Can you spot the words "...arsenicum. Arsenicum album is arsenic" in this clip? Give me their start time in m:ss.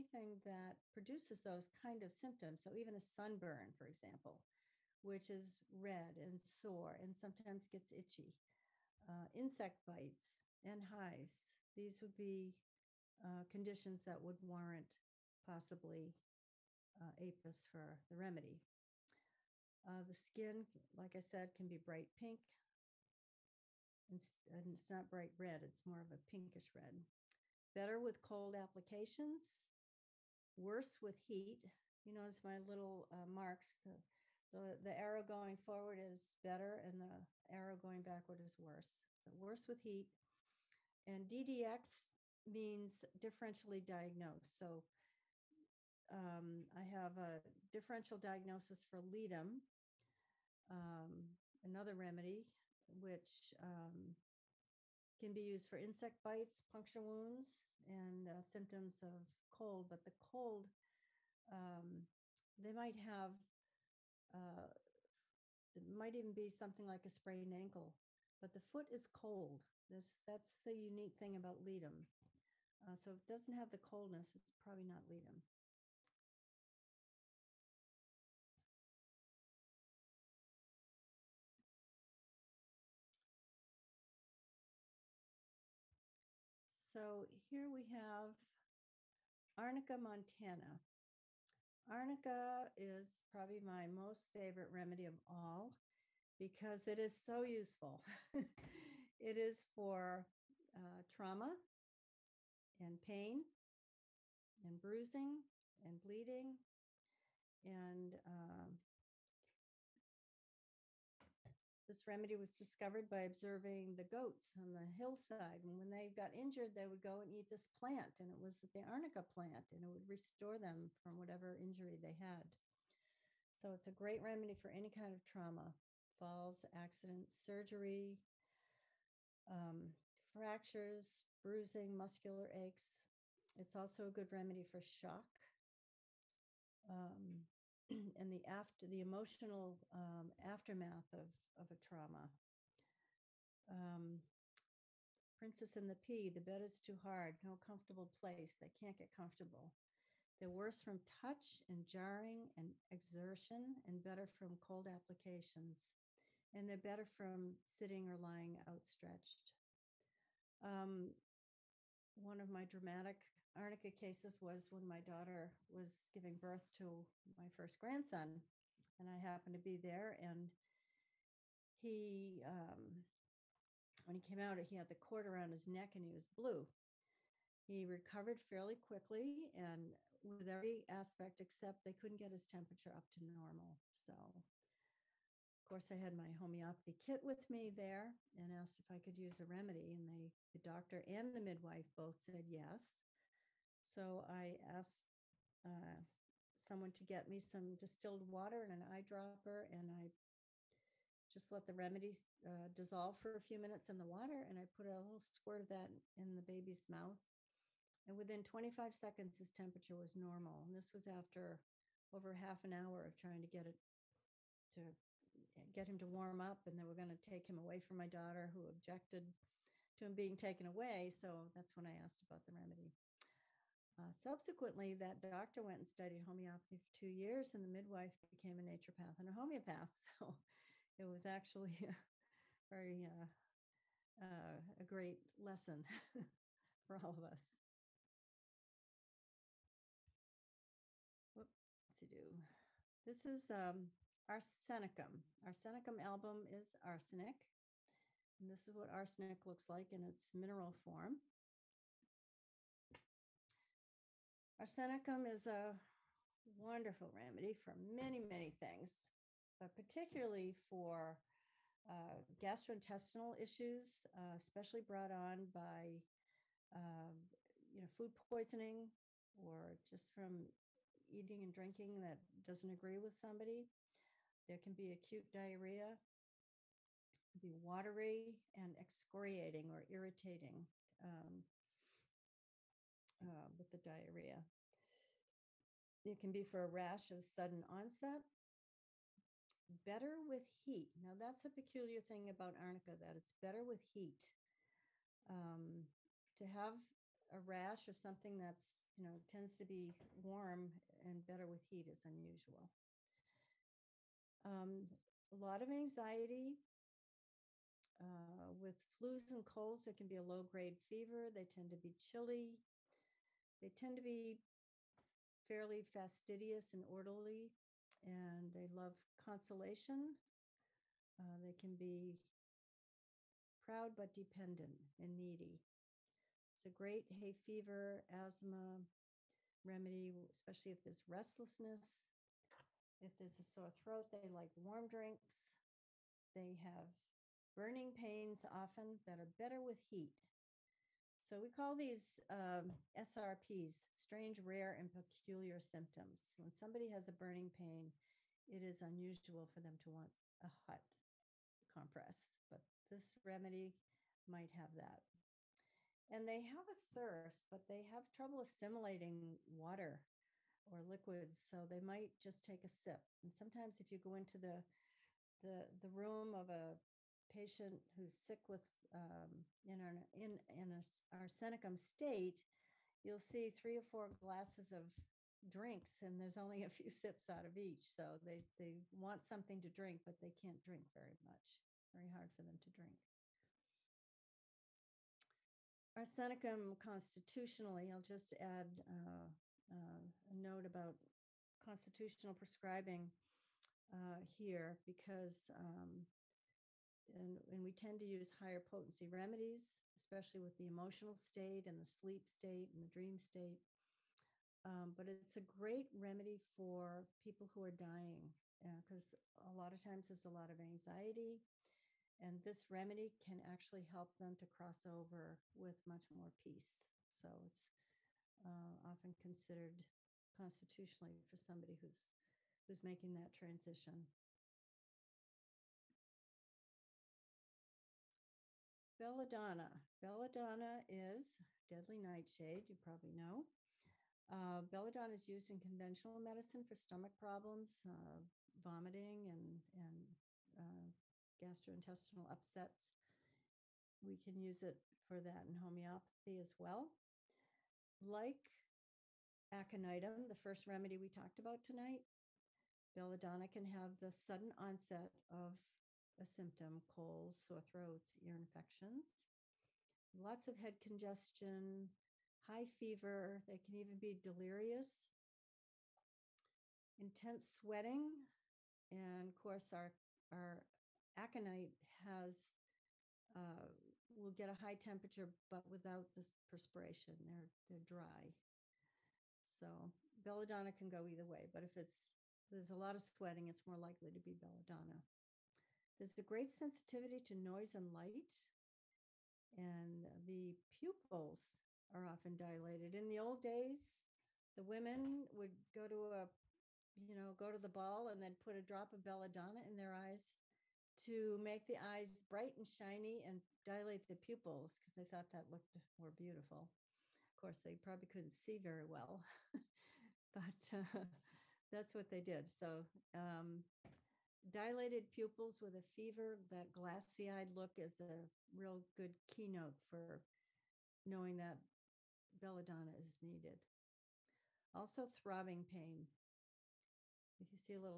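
4:04.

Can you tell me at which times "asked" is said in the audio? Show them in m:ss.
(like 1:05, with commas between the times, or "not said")
3:08, 3:14, 3:41.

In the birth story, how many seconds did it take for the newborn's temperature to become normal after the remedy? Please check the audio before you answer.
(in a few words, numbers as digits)
25.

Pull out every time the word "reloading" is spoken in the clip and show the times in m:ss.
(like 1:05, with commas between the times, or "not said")
not said.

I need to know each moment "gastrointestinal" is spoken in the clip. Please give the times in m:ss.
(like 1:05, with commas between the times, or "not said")
4:22, 7:21.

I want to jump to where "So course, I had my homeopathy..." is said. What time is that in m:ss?
3:03.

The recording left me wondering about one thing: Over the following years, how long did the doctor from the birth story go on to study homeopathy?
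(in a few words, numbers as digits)
two years.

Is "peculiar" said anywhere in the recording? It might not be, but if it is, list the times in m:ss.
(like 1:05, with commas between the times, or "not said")
4:51, 5:44.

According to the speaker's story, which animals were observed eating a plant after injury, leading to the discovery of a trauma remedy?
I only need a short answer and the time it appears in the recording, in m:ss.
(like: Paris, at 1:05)
goats, at 1:54.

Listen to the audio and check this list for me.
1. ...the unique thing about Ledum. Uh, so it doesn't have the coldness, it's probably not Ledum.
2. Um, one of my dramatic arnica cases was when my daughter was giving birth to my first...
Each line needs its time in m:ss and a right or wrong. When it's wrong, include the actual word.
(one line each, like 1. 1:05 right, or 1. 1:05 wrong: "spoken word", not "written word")
1. 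1:10 right
2. 2:40 right.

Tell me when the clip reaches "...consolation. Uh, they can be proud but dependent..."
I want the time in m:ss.
5:19.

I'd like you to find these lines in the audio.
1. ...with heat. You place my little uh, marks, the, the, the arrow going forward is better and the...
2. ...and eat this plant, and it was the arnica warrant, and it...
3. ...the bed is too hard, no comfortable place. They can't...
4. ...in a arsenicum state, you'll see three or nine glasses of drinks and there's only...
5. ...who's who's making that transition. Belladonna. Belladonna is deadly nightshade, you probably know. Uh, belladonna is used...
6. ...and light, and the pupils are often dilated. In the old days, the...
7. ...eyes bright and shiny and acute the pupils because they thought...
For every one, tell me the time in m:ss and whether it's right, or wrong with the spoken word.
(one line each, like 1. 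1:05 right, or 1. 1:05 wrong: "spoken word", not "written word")
1. 0:30 wrong: "notice", not "place"
2. 1:57 wrong: "plant", not "warrant"
3. 2:26 right
4. 6:10 wrong: "four", not "nine"
5. 7:01 right
6. 8:07 right
7. 8:21 wrong: "dilate", not "acute".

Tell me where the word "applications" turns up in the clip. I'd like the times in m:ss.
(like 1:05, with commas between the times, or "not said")
0:28, 2:34.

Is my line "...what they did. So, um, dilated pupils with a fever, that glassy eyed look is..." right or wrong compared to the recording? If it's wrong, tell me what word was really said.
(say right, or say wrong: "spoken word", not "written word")
right.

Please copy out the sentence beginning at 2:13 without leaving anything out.
It's also a good remedy for shock.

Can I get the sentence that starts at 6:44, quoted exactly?
Um, but it's a great remedy for people who are dying because uh, a lot of times there's a lot of anxiety.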